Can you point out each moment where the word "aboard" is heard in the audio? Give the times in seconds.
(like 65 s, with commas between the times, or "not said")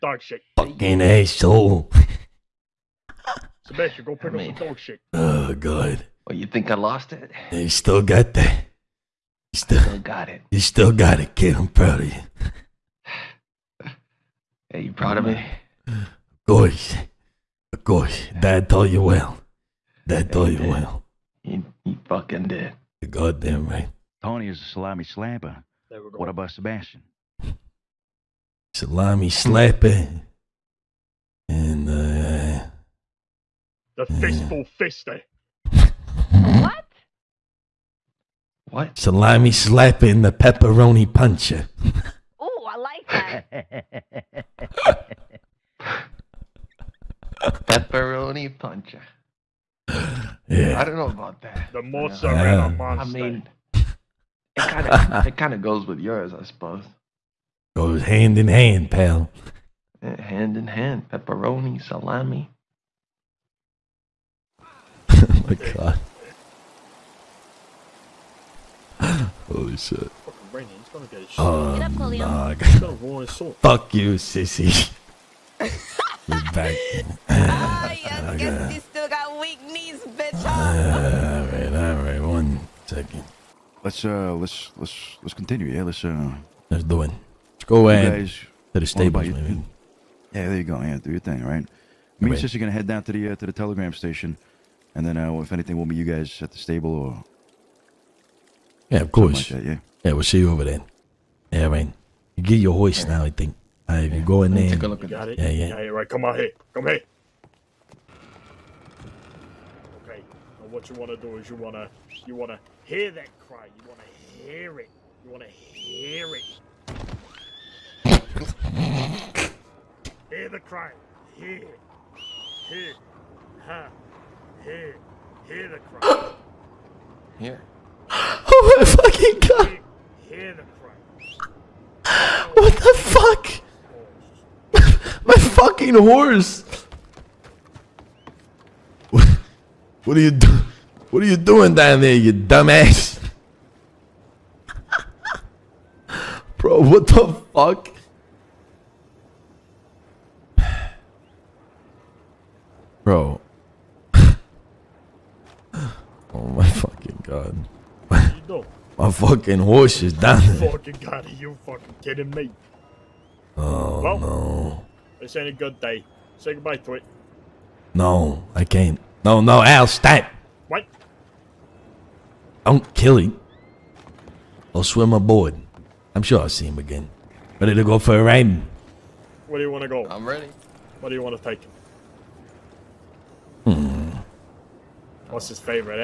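175 s.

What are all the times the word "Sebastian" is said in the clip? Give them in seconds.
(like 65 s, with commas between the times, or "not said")
3 s, 26 s.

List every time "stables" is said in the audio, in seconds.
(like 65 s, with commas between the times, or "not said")
88 s, 96 s.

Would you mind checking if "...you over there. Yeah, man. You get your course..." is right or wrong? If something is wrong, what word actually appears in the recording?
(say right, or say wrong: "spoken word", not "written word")
wrong: "horse", not "course".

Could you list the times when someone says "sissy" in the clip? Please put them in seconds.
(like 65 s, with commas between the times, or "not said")
74 s, 92 s.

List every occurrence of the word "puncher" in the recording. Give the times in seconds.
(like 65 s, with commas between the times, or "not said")
41 s, 48 s.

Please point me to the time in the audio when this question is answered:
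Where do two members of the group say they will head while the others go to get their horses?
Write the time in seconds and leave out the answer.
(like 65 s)
93 s.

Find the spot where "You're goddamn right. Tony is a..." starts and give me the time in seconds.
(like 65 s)
23 s.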